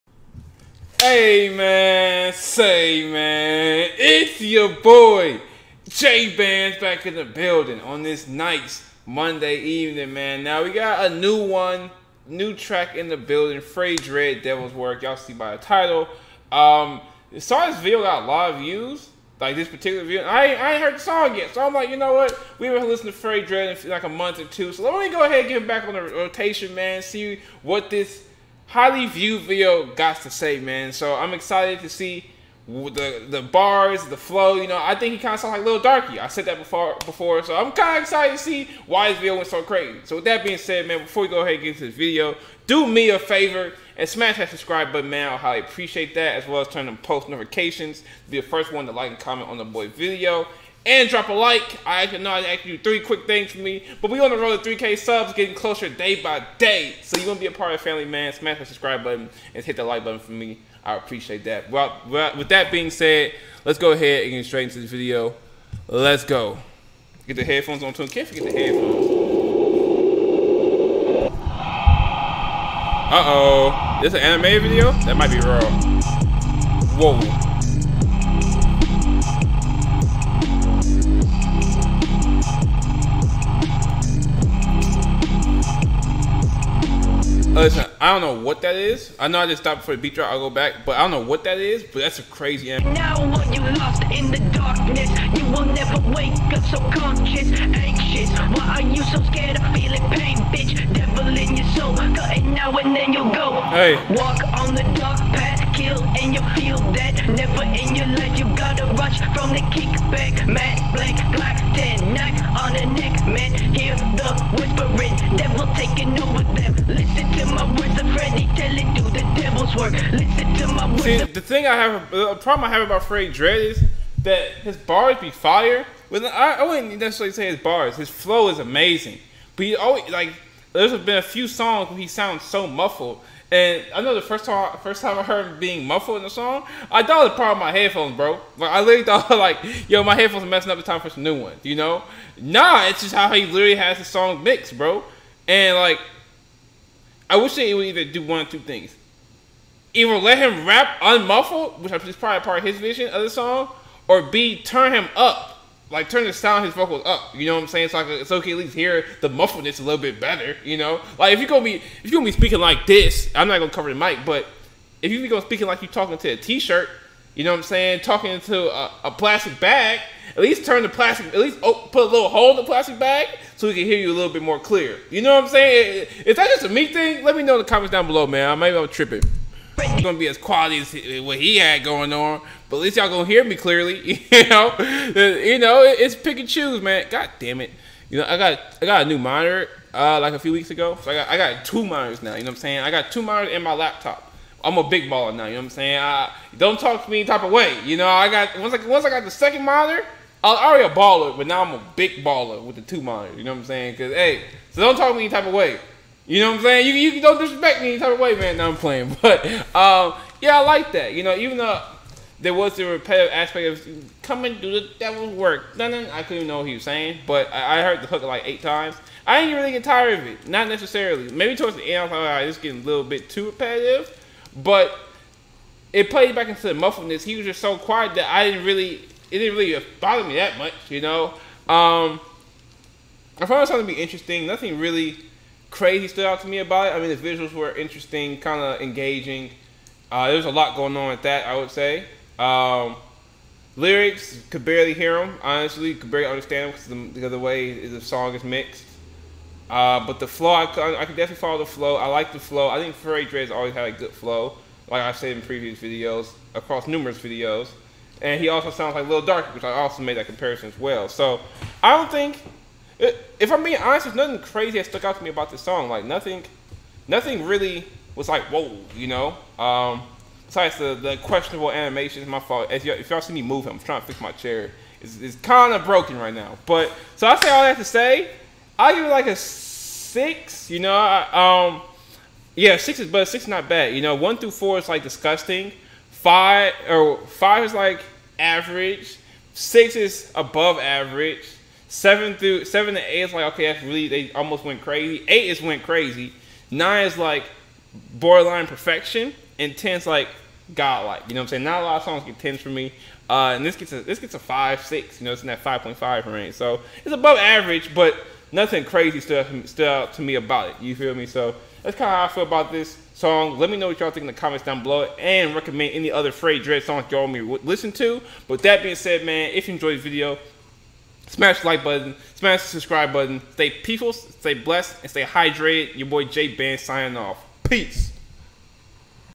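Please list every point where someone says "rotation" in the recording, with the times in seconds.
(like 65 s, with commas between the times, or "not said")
26 s.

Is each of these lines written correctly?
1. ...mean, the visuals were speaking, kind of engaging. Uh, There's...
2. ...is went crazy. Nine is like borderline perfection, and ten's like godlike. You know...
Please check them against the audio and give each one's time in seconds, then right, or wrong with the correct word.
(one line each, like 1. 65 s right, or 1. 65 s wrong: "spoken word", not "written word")
1. 236 s wrong: "interesting", not "speaking"
2. 295 s right.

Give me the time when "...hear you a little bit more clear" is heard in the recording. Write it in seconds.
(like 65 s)
173 s.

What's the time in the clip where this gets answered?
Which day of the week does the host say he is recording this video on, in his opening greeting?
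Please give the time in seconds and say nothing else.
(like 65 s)
9 s.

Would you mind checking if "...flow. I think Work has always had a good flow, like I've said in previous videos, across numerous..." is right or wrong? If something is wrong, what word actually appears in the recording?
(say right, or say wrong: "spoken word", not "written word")
wrong: "Furry", not "Work".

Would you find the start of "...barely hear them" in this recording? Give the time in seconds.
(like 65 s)
244 s.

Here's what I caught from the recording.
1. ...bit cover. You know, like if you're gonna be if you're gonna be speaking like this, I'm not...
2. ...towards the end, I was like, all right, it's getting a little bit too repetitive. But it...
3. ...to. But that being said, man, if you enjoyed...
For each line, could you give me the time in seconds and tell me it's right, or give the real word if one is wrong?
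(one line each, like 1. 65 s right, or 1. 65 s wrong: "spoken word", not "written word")
1. 159 s wrong: "better", not "cover"
2. 221 s right
3. 317 s right.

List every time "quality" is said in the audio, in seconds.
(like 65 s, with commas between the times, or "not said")
180 s.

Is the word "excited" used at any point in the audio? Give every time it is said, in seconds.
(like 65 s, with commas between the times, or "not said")
31 s, 38 s.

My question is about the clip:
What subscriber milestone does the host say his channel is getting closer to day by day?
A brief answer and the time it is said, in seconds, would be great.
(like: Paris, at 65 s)
3K subs, at 54 s.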